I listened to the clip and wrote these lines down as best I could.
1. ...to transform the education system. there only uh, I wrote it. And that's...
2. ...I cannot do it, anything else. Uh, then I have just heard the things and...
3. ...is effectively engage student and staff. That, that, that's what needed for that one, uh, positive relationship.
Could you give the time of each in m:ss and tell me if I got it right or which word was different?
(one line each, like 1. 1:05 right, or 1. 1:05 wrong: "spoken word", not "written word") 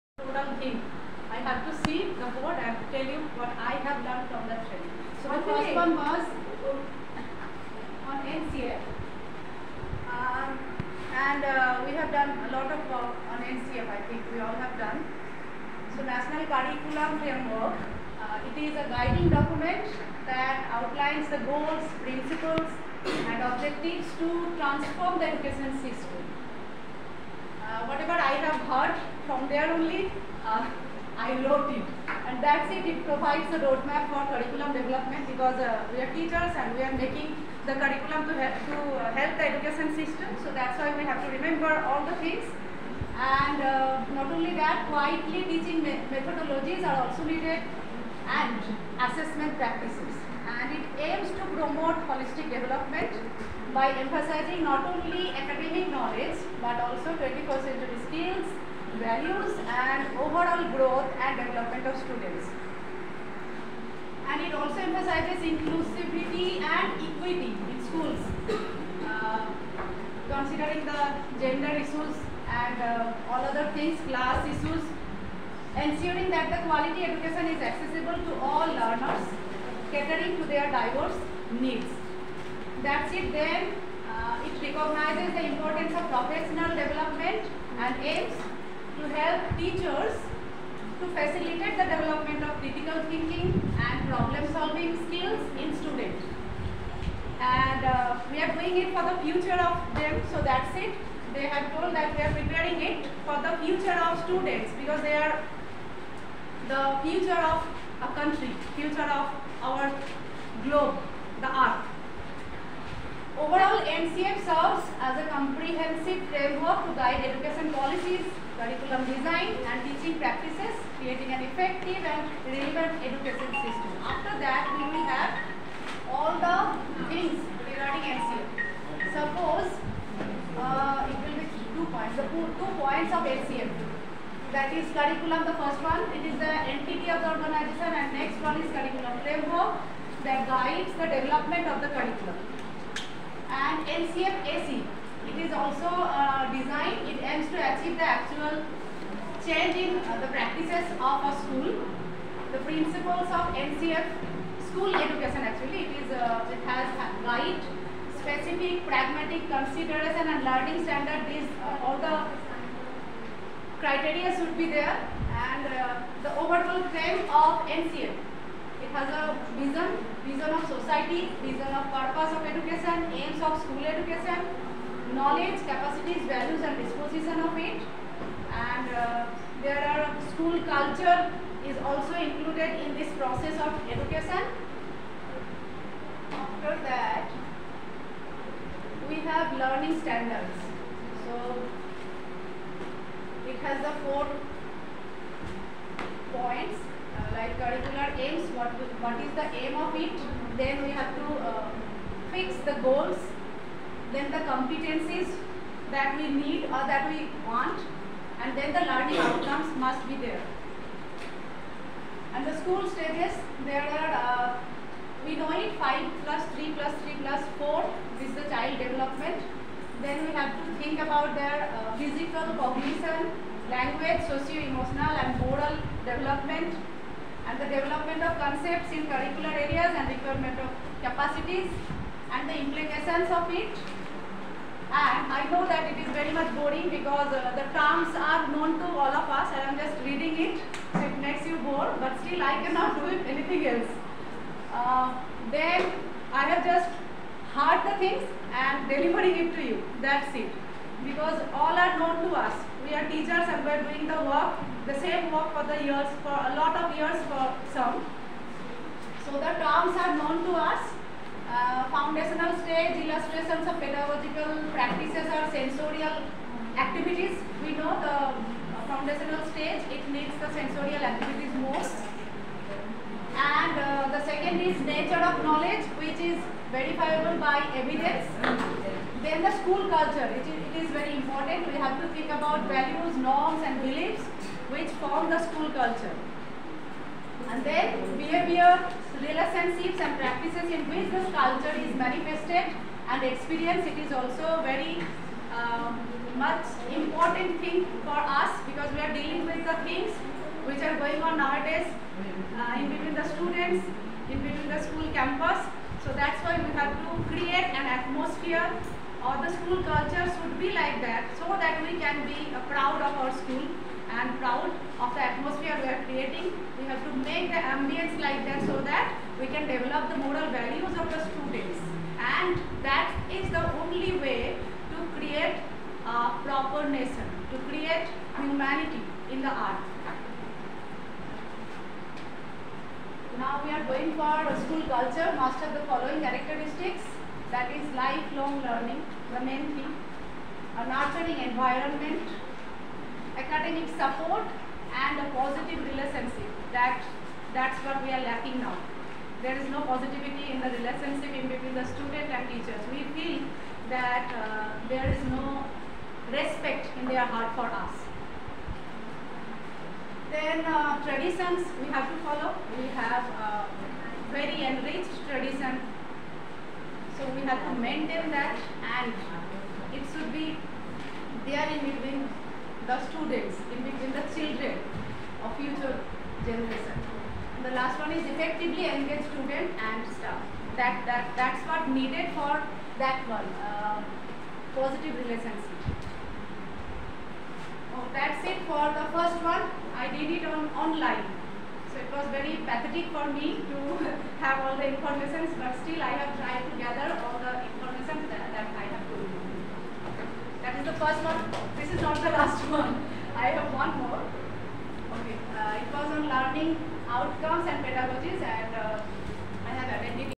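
1. 0:24 right
2. 4:02 right
3. 6:18 right.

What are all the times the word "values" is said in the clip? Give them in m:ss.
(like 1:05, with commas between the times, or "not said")
0:58, 2:56, 4:42, 5:20.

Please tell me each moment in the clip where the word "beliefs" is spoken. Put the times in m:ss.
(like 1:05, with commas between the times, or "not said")
4:43.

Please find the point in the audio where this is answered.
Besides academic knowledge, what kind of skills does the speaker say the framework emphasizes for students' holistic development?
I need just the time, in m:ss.
0:57.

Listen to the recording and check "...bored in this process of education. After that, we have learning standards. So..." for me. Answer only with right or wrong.
wrong.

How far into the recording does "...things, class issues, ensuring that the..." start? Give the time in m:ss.
1:13.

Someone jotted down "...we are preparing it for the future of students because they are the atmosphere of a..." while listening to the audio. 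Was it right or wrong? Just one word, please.
wrong.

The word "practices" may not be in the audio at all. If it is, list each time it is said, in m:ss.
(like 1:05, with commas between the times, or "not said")
0:49, 2:30, 4:24, 4:50.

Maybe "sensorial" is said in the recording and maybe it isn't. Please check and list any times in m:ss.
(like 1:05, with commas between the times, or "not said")
4:25, 4:30.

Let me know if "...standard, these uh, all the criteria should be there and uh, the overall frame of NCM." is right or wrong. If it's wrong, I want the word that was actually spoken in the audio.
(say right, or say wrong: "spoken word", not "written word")
right.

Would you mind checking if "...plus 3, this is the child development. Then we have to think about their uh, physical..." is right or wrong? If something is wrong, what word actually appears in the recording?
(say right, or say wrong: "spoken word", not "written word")
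wrong: "4", not "3".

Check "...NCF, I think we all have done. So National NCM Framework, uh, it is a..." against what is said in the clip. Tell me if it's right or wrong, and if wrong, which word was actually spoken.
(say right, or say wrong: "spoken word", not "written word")
wrong: "Curriculum", not "NCM".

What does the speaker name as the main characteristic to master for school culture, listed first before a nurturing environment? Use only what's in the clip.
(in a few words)
Lifelong learning.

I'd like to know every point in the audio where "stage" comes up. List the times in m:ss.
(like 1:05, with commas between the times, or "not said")
3:32, 4:22, 4:29.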